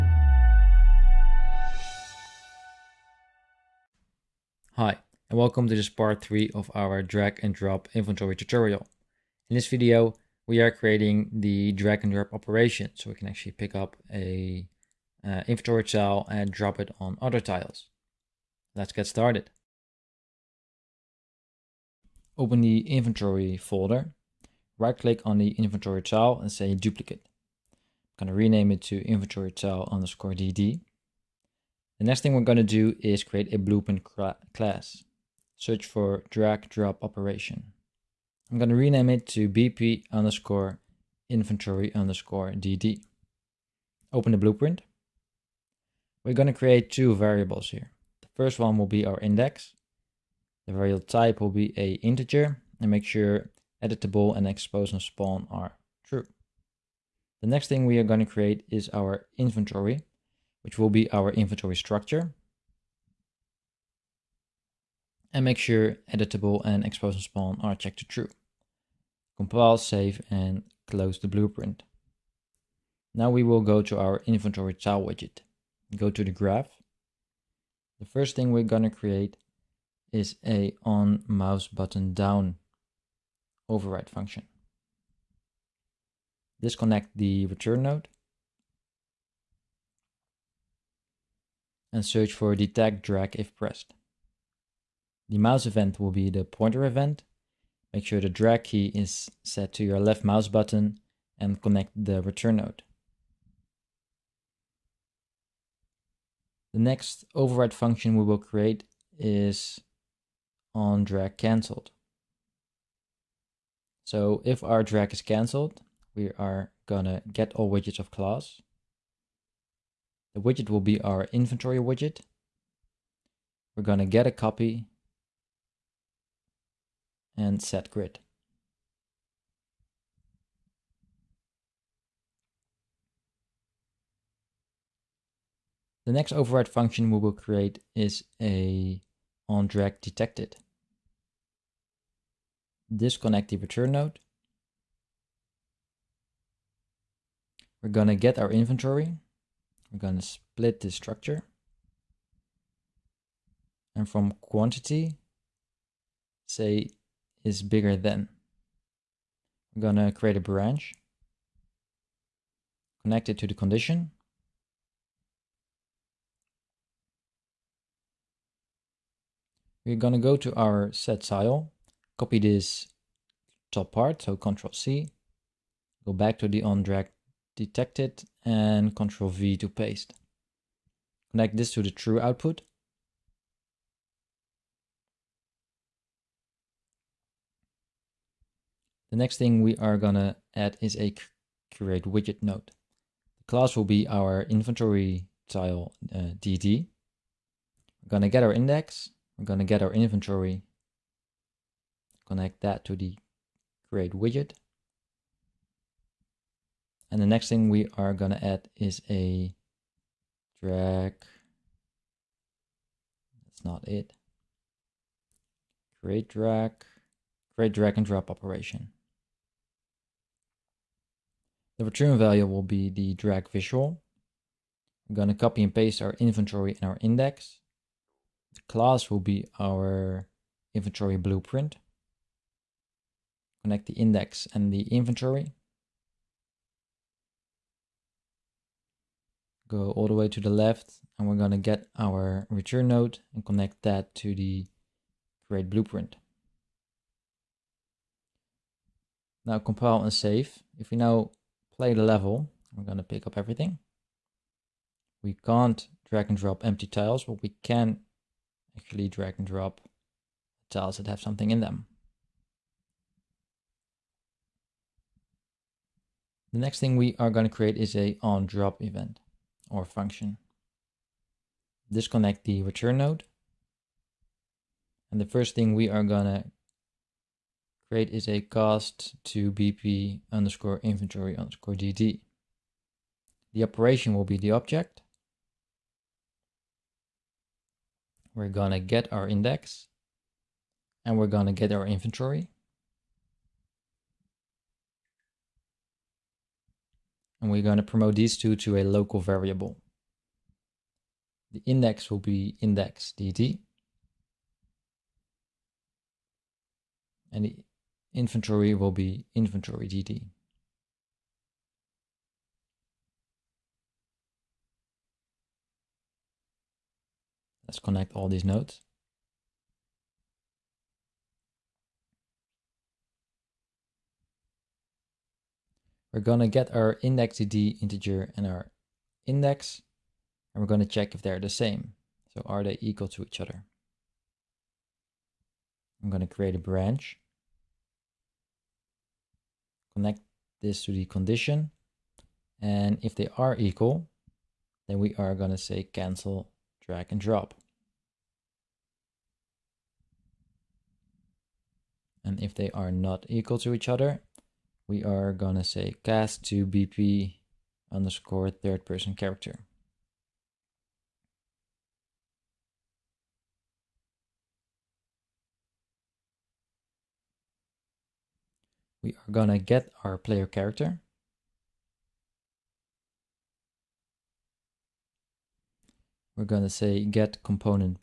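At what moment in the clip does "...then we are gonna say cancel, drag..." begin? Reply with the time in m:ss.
5:44.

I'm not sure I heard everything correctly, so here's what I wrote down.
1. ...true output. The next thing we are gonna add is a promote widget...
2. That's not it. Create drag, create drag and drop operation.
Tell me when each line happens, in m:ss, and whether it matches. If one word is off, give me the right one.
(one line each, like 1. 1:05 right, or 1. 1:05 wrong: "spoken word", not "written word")
1. 3:01 wrong: "create", not "promote"
2. 3:33 right.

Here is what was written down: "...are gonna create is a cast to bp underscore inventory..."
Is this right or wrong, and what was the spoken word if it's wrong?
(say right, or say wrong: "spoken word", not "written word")
right.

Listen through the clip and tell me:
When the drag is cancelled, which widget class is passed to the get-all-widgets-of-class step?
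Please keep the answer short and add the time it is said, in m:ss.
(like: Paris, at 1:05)
inventory widget, at 2:01.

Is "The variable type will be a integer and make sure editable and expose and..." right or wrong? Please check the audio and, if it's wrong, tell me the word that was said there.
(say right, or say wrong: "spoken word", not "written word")
right.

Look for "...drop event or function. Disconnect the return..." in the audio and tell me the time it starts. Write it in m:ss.
4:28.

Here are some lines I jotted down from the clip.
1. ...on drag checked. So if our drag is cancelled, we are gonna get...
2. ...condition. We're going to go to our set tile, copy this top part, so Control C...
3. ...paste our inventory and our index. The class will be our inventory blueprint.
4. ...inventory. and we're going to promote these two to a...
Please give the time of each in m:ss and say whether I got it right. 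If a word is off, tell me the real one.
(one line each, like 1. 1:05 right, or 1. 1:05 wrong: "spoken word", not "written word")
1. 1:50 wrong: "cancelled", not "checked"
2. 2:43 right
3. 3:45 right
4. 4:51 right.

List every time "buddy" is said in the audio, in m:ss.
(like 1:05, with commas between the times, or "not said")
not said.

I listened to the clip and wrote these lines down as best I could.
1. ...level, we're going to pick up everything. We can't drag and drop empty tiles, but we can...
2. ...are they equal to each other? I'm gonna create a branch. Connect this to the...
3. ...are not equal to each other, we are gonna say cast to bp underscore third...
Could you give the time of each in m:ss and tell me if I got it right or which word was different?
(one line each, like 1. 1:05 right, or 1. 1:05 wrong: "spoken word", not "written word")
1. 4:12 right
2. 5:32 right
3. 5:52 right.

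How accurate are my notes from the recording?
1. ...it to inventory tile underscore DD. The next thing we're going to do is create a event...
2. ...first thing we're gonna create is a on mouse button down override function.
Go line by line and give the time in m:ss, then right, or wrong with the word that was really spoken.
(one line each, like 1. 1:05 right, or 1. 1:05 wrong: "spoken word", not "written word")
1. 0:28 wrong: "blueprint", not "event"
2. 1:18 right.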